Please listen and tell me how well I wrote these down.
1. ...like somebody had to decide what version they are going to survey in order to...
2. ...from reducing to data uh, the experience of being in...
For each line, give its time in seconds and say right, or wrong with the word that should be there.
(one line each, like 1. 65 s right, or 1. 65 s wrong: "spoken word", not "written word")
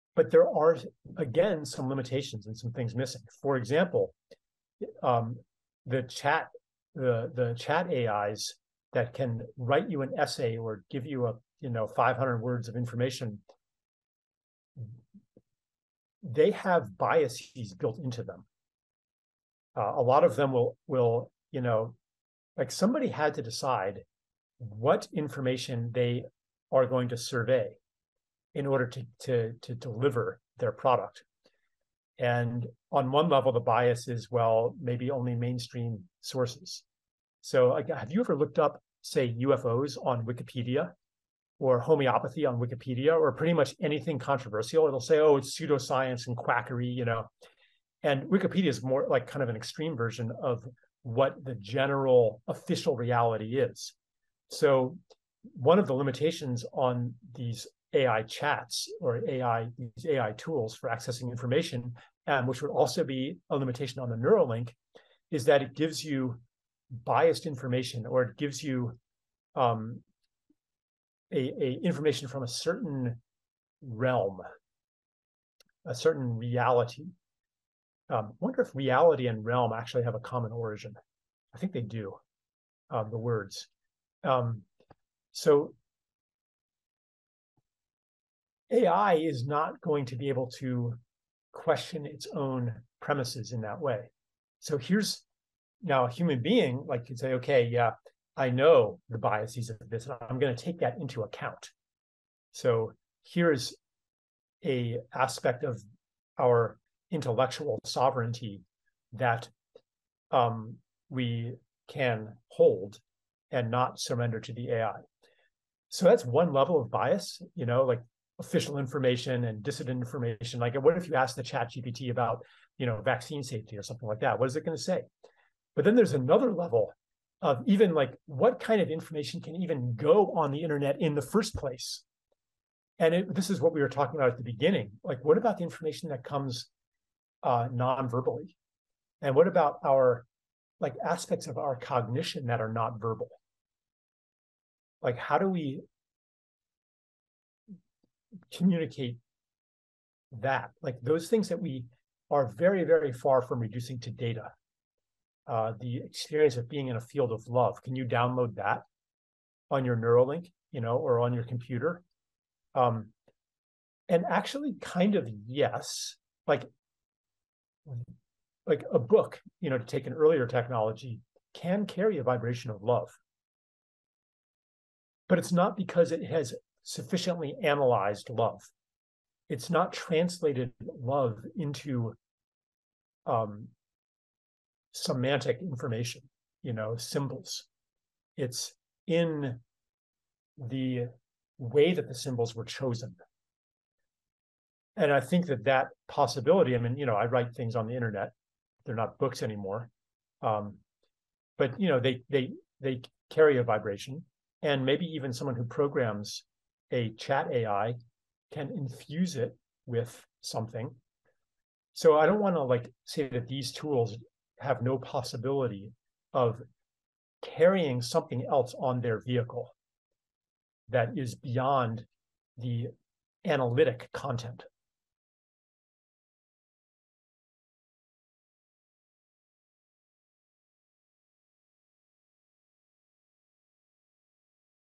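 1. 22 s wrong: "information", not "version"
2. 153 s right.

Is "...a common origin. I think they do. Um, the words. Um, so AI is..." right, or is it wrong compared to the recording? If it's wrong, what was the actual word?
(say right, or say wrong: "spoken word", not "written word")
right.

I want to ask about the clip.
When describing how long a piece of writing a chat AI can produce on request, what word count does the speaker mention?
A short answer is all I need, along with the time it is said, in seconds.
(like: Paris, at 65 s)
500 words, at 11 s.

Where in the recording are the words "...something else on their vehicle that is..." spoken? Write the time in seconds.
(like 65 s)
218 s.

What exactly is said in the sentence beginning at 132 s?
And it, this is what we were talking about at the beginning.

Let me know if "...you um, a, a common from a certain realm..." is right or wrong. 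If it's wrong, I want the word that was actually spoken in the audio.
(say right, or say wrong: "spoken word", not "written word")
wrong: "information", not "common".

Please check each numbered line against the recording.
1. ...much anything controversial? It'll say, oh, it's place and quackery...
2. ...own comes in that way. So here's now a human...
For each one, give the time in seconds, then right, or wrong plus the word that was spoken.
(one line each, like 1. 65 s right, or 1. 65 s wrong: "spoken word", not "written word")
1. 43 s wrong: "pseudoscience", not "place"
2. 92 s wrong: "premises", not "comes".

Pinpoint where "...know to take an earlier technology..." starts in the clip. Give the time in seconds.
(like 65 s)
169 s.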